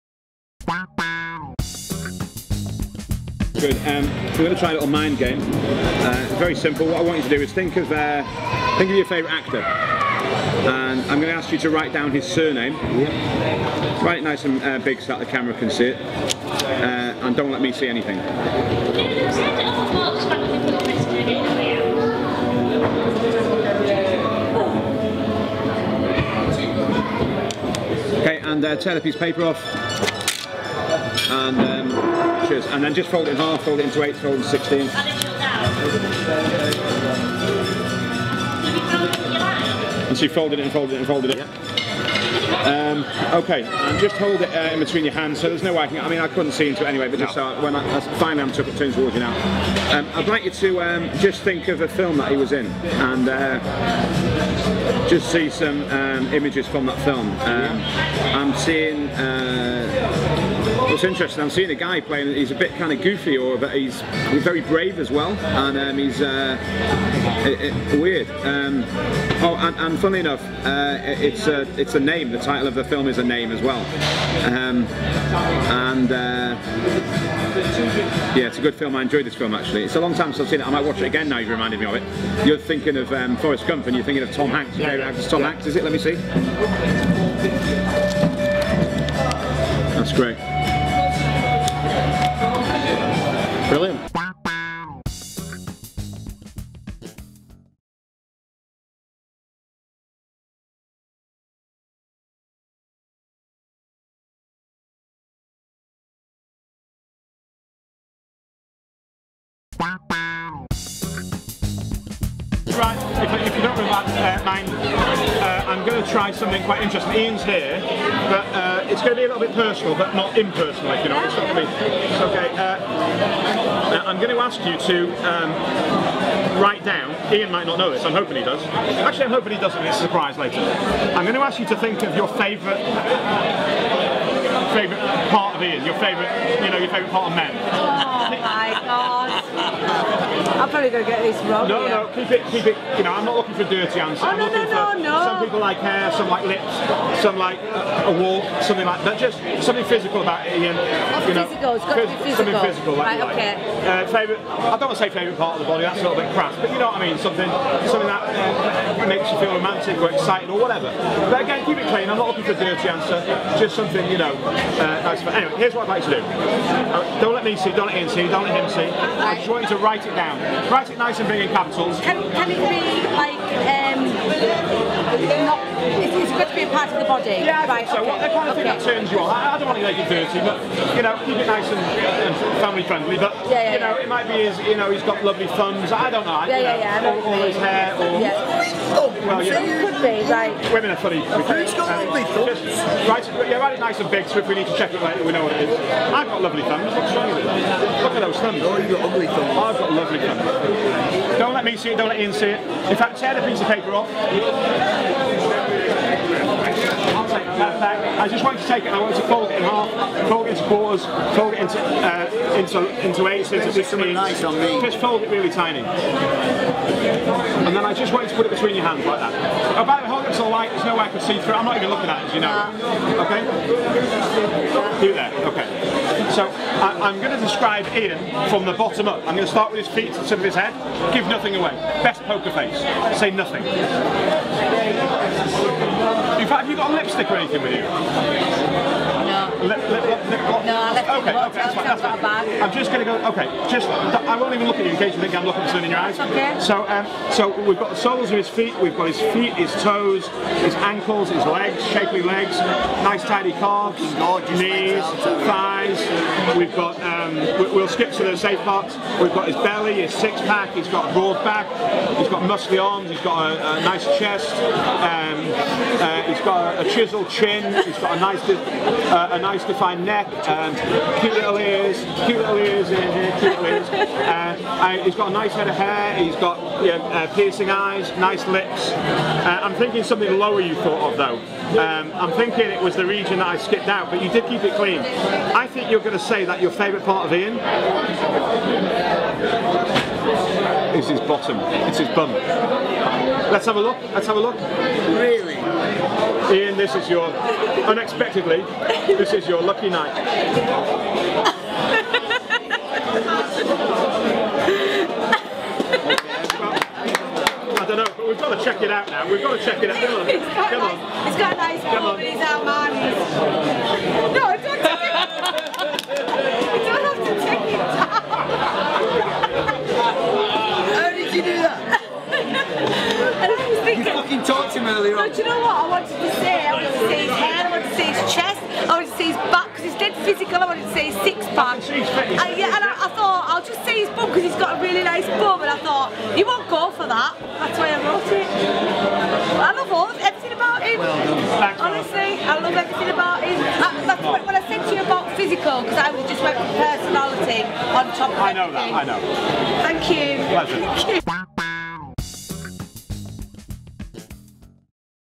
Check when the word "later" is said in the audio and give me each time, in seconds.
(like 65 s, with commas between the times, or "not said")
130 s, 195 s.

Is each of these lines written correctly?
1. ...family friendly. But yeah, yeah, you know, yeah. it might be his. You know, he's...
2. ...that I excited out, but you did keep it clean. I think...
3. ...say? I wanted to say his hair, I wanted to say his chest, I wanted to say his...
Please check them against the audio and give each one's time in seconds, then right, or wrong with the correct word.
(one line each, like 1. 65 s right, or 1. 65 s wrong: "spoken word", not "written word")
1. 182 s right
2. 283 s wrong: "skipped", not "excited"
3. 326 s right.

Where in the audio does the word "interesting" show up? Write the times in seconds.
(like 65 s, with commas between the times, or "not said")
61 s, 116 s.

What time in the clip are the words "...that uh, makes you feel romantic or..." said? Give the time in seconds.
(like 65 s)
158 s.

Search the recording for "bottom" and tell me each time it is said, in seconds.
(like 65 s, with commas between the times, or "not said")
228 s, 291 s.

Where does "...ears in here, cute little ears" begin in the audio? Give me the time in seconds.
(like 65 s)
272 s.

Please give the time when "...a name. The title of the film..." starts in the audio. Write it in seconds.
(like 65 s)
71 s.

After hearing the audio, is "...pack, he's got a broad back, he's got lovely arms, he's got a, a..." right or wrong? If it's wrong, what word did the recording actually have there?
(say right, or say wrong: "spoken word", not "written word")
wrong: "muscly", not "lovely".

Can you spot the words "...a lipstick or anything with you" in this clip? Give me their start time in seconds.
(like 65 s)
236 s.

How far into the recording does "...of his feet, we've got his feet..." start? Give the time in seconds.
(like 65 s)
248 s.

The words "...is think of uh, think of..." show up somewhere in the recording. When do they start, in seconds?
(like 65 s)
7 s.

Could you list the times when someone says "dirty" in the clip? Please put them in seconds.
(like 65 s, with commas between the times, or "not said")
143 s, 162 s, 180 s.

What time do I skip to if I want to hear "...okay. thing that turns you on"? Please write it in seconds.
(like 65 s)
178 s.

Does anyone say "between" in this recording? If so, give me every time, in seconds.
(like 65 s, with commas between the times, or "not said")
44 s, 218 s.